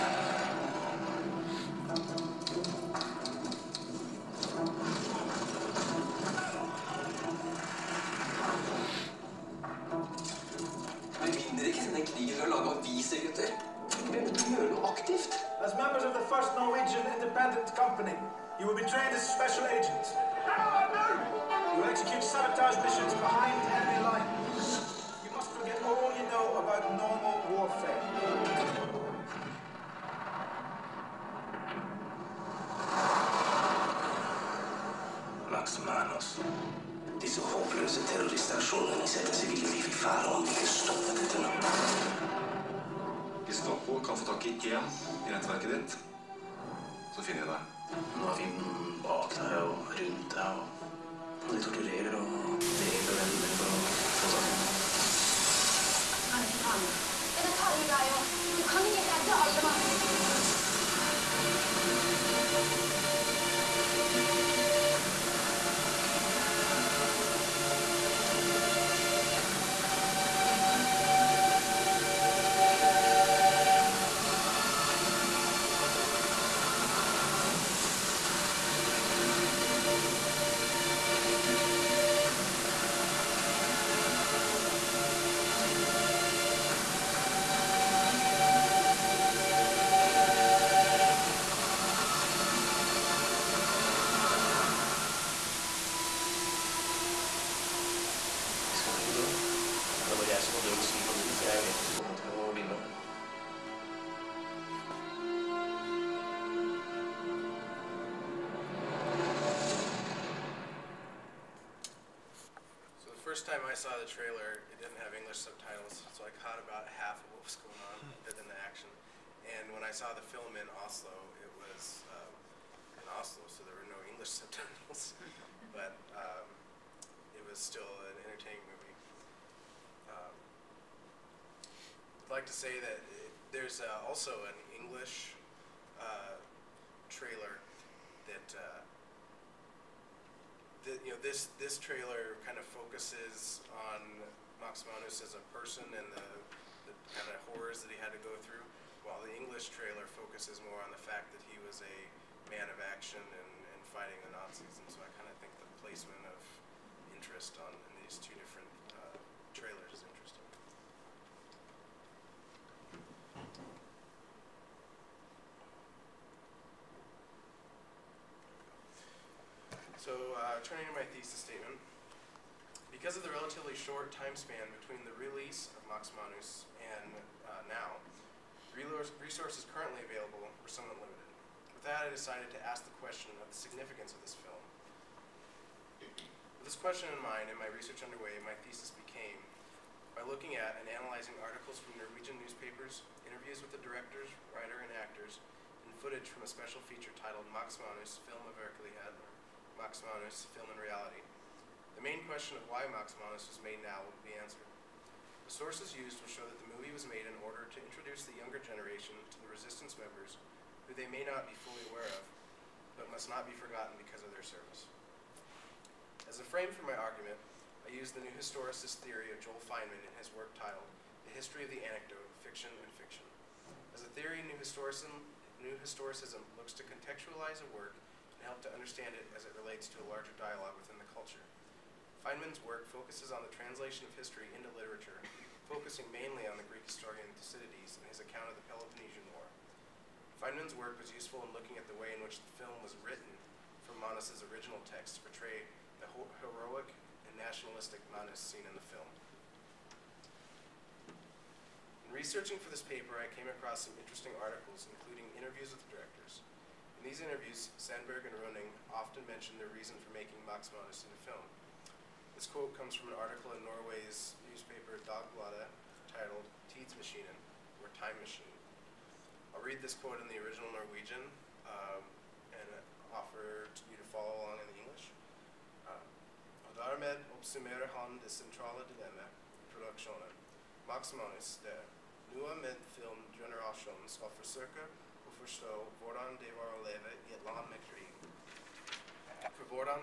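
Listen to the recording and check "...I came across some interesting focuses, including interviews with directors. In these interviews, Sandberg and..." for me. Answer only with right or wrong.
wrong.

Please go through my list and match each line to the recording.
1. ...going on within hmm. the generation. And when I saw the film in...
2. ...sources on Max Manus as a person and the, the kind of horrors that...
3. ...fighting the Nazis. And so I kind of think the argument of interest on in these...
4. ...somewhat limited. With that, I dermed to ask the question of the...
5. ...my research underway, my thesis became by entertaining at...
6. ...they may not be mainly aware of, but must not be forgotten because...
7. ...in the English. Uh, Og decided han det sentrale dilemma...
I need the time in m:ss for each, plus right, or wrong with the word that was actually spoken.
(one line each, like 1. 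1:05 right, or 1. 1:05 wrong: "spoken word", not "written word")
1. 1:57 wrong: "action", not "generation"
2. 2:22 wrong: "focuses", not "sources"
3. 2:33 wrong: "placement", not "argument"
4. 3:00 wrong: "decided", not "dermed"
5. 3:07 wrong: "looking", not "entertaining"
6. 3:30 wrong: "fully", not "mainly"
7. 4:34 wrong: "dermed", not "decided".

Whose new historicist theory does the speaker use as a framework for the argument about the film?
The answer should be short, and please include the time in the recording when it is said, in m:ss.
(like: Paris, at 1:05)
Joel Fineman, at 3:39.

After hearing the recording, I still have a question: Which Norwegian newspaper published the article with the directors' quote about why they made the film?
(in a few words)
Dagbladet.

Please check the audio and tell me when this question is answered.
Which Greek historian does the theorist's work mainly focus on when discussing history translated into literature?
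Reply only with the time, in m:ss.
3:57.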